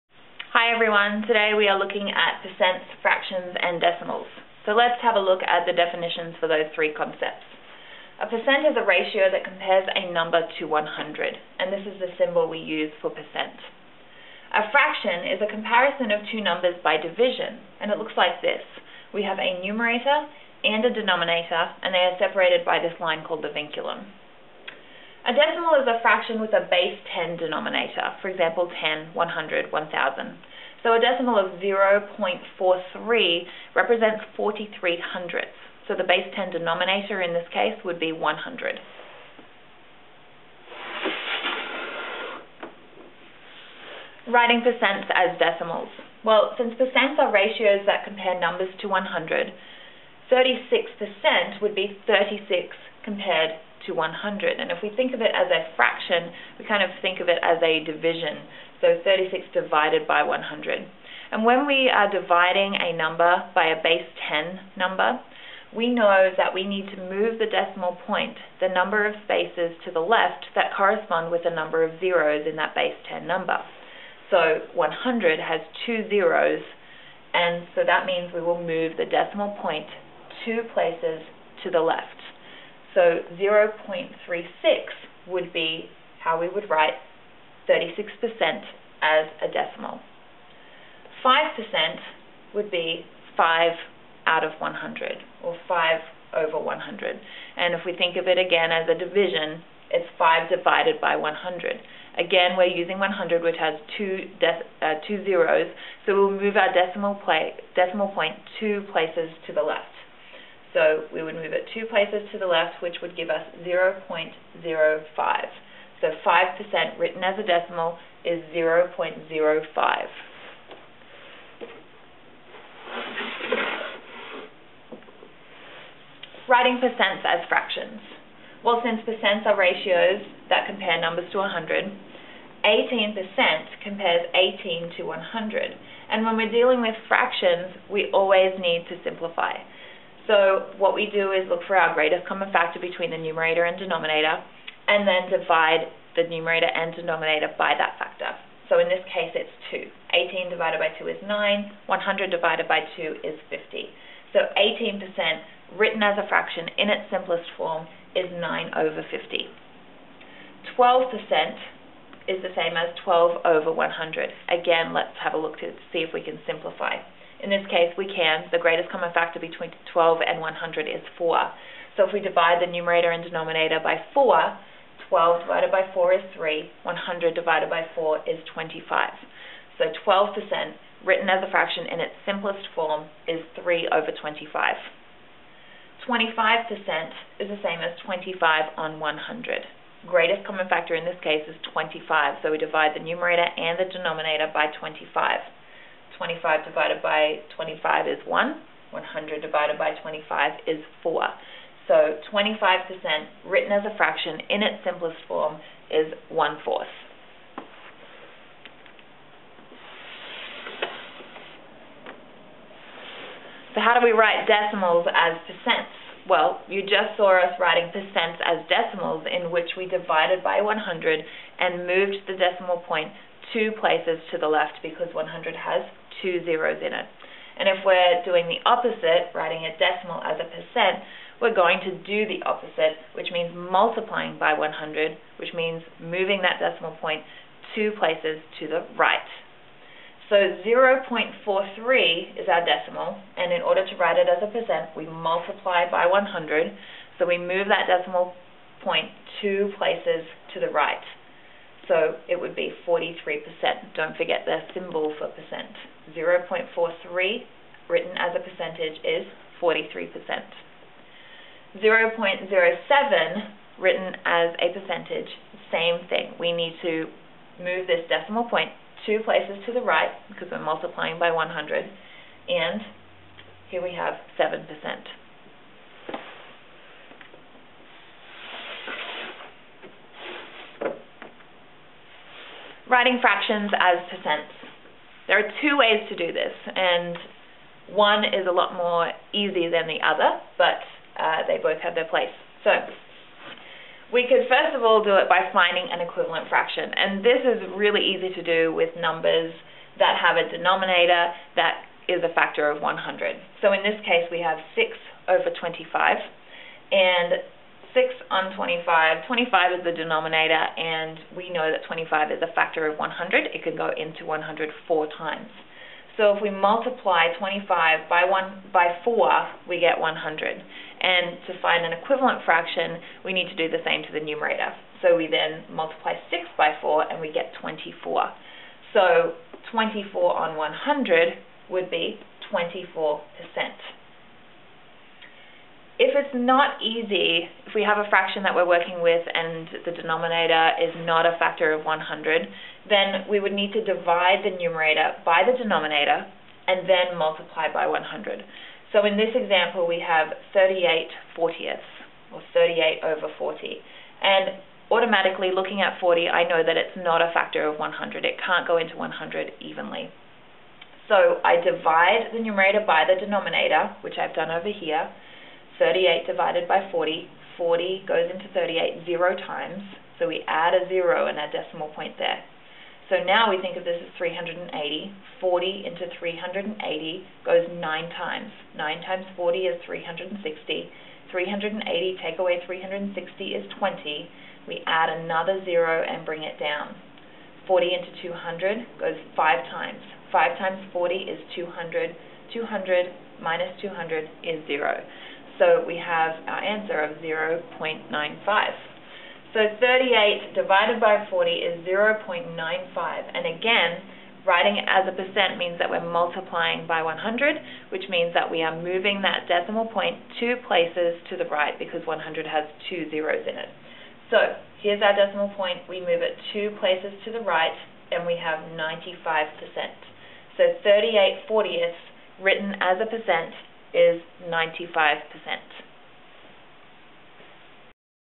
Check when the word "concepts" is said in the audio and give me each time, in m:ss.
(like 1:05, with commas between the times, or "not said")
0:06.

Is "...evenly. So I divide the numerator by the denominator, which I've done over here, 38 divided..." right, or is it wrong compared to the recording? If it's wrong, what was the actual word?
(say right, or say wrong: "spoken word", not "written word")
right.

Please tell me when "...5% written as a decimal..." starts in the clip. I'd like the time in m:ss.
1:56.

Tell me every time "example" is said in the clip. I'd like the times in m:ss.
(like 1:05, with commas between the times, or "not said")
0:28, 5:49.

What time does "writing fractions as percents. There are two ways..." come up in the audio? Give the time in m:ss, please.
4:42.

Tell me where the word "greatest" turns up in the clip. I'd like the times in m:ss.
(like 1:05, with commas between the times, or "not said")
2:21, 2:48, 3:10.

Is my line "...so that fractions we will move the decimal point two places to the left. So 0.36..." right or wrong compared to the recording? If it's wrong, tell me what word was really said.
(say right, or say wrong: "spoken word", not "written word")
wrong: "means", not "fractions".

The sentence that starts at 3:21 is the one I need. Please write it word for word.
So 25% written as a fraction in its simplest form is 1 fourth.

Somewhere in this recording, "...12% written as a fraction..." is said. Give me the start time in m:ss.
3:00.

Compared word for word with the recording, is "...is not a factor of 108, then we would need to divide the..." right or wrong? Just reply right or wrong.
wrong.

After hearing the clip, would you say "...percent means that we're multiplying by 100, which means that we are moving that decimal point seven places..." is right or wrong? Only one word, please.
wrong.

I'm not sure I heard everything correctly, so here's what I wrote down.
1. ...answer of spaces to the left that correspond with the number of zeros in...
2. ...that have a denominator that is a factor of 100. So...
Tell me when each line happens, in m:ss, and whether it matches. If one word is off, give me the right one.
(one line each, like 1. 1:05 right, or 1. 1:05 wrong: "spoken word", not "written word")
1. 1:08 wrong: "number", not "answer"
2. 4:59 right.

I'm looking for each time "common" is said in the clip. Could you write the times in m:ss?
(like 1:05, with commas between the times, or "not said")
2:22, 2:48, 3:10.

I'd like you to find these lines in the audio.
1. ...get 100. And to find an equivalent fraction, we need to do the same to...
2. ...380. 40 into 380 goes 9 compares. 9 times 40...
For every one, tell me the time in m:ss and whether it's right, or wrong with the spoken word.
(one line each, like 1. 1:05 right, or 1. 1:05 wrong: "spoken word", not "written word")
1. 5:19 right
2. 6:14 wrong: "times", not "compares".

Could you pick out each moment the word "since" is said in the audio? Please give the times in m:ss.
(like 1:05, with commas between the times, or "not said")
0:46, 2:08.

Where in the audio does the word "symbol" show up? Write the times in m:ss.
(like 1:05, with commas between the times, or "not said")
0:12, 4:14.